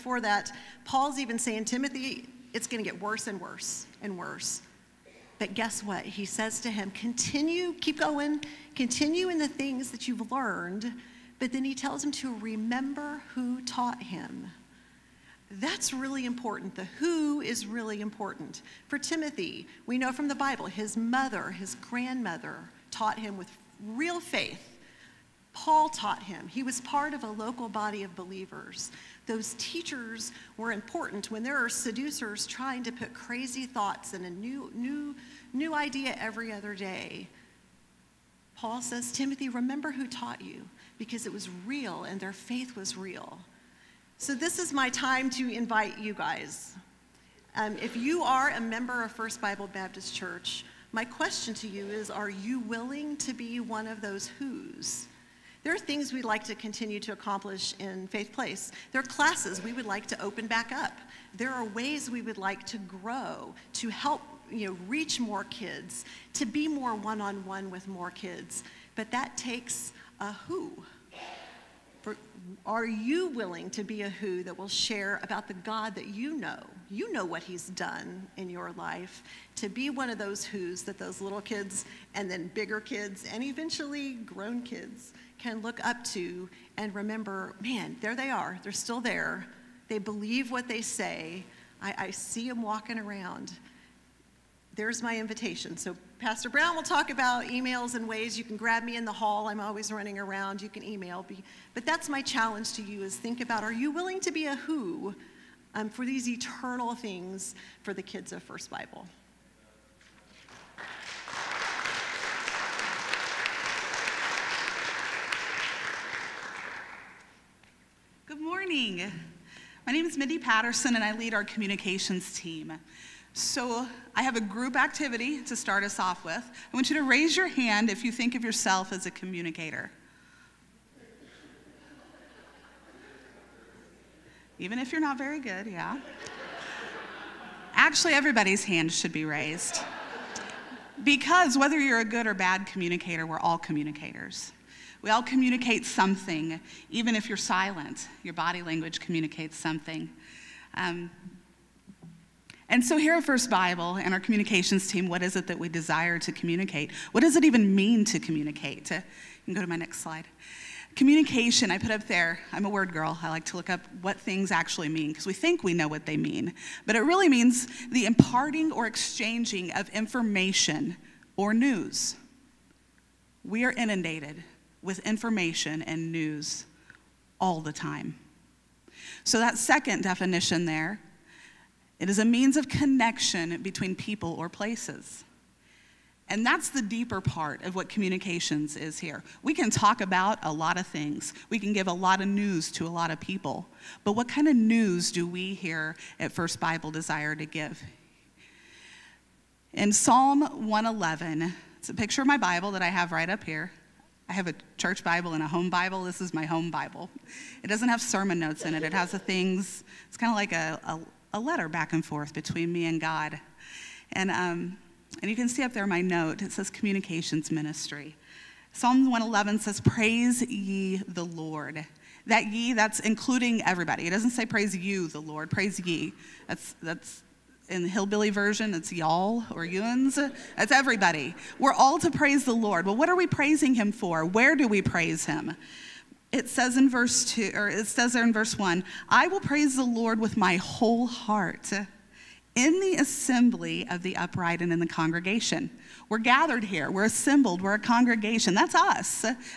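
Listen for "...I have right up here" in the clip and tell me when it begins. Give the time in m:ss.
3:22.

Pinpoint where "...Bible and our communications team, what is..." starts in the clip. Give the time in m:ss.
2:33.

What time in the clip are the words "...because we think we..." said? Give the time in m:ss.
2:45.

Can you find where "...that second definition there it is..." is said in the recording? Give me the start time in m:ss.
2:59.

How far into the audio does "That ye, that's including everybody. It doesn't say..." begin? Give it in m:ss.
3:42.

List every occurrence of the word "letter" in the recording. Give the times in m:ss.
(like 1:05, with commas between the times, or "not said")
3:31.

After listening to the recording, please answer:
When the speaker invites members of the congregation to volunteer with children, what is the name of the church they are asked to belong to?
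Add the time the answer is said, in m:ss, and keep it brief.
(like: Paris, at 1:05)
First Bible Baptist Church, at 0:49.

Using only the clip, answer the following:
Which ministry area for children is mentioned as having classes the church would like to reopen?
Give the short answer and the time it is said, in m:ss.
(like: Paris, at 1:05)
Faith Place, at 0:58.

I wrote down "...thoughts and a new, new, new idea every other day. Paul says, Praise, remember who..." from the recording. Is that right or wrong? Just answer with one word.
wrong.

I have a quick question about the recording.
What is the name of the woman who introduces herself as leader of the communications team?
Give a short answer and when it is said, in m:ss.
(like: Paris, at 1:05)
Mindy Patterson, at 2:00.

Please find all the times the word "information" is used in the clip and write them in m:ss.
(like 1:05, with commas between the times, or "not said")
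2:49, 2:54.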